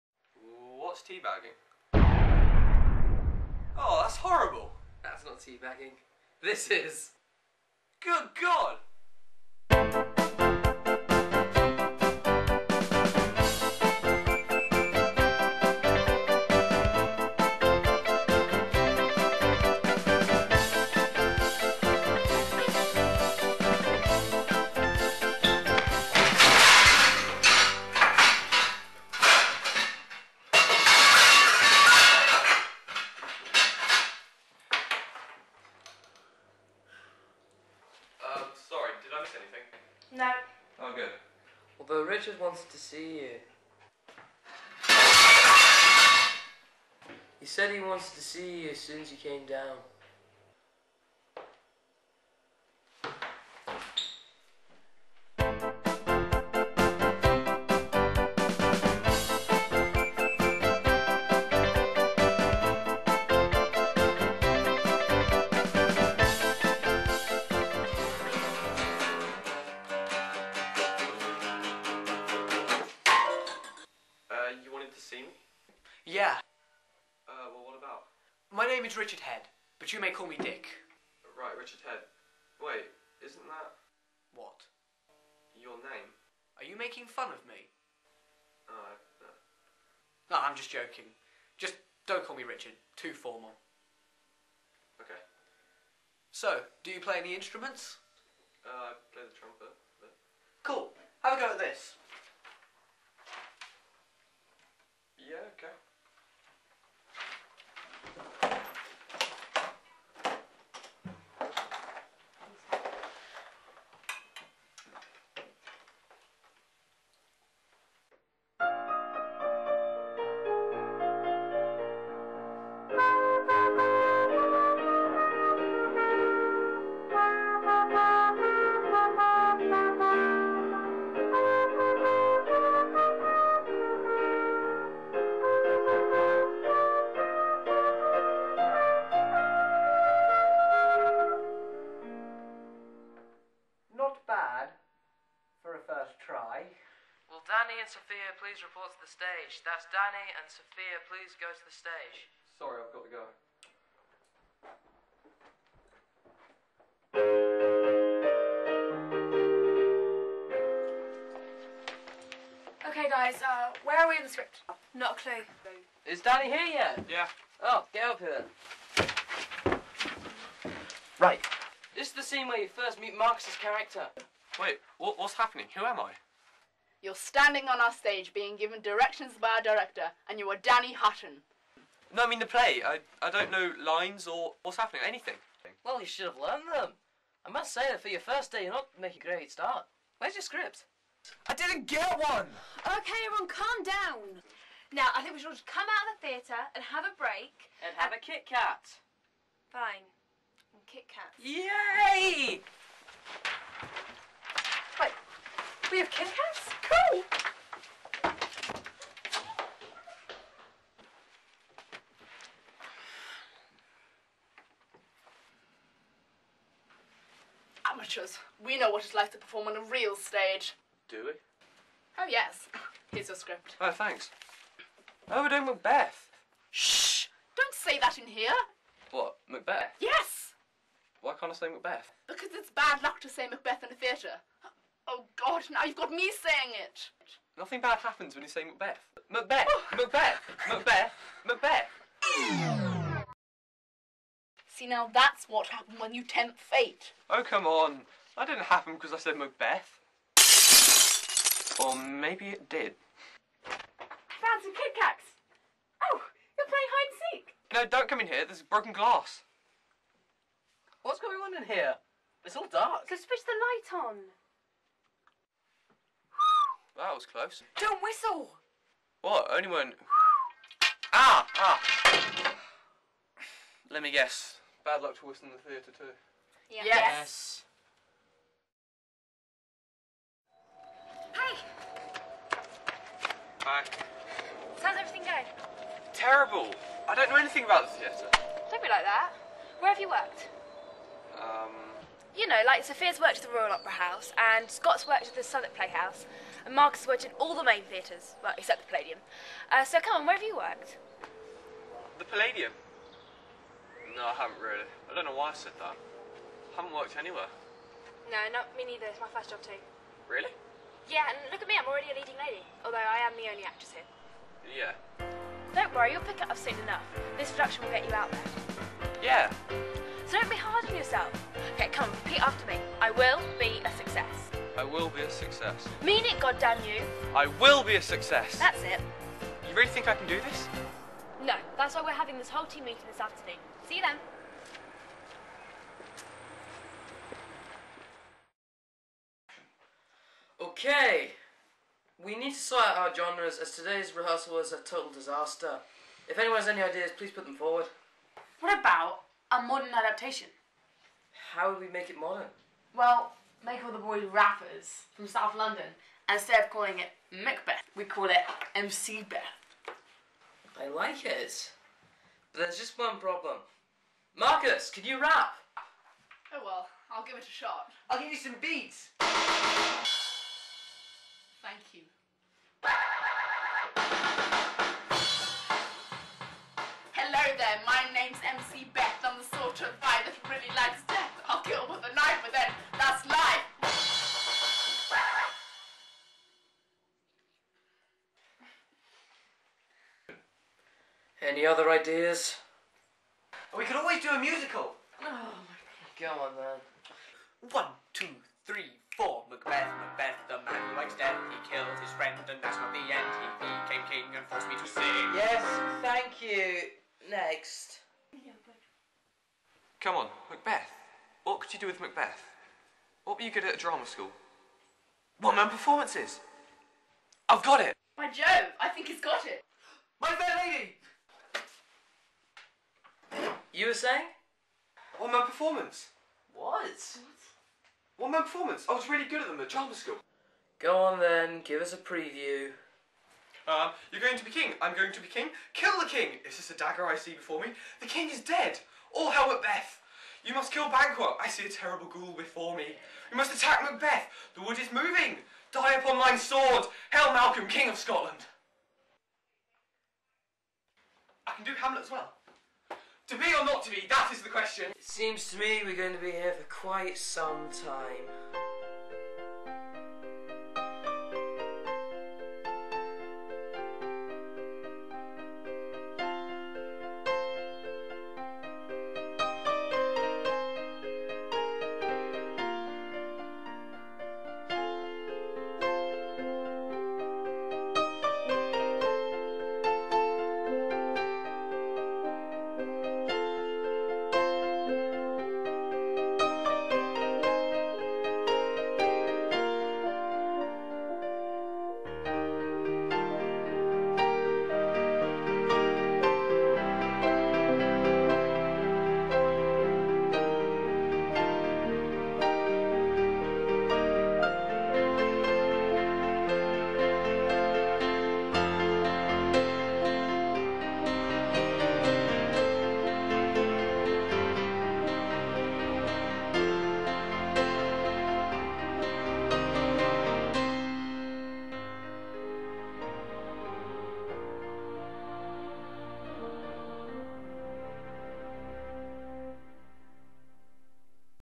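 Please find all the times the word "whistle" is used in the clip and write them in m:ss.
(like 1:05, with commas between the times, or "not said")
4:28.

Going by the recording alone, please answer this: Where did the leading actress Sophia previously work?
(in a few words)
Royal Opera House.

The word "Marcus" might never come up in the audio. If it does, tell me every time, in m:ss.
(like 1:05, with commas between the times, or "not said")
2:53, 4:56, 6:04.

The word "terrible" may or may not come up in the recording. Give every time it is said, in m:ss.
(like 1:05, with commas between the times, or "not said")
4:46, 7:21.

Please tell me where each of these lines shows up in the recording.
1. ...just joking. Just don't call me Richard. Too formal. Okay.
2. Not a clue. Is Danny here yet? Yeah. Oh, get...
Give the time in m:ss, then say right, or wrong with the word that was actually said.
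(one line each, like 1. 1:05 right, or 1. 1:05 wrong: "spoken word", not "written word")
1. 1:30 right
2. 2:44 right.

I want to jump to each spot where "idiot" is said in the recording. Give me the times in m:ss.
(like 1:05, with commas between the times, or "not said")
not said.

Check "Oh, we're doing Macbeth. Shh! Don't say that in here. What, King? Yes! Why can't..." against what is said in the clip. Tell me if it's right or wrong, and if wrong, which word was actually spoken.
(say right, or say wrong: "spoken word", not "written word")
wrong: "Macbeth", not "King".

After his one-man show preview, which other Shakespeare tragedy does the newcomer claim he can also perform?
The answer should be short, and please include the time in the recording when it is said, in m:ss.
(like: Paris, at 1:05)
Hamlet, at 7:31.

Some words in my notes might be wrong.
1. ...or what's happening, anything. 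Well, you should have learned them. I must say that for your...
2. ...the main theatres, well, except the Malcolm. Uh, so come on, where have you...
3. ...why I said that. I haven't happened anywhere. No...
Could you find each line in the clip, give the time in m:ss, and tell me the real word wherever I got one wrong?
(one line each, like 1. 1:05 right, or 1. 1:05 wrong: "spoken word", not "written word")
1. 3:04 right
2. 4:57 wrong: "Palladium", not "Malcolm"
3. 5:05 wrong: "worked", not "happened".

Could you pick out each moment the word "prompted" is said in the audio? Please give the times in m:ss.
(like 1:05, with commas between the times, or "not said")
not said.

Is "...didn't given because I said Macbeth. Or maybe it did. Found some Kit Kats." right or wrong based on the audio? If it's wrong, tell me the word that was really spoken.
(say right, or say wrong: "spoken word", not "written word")
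wrong: "happen", not "given".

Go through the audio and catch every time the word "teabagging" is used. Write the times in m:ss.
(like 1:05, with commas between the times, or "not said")
0:01, 0:05.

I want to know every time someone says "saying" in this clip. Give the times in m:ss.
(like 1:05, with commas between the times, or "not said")
3:56, 7:03.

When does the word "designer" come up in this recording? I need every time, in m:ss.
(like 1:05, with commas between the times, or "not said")
not said.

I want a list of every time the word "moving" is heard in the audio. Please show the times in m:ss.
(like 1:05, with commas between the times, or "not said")
7:24.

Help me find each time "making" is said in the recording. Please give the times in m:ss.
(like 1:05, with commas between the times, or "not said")
1:26, 3:09.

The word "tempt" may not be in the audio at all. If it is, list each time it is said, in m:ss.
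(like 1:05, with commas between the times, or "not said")
4:06.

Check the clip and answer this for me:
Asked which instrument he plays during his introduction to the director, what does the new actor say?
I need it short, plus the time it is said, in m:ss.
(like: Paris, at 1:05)
Trumpet, at 1:39.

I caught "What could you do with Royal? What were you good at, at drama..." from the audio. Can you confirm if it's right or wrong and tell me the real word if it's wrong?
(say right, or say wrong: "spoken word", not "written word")
wrong: "Macbeth", not "Royal".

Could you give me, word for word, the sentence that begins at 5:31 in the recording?
No, that's why we're having this whole team meeting this afternoon.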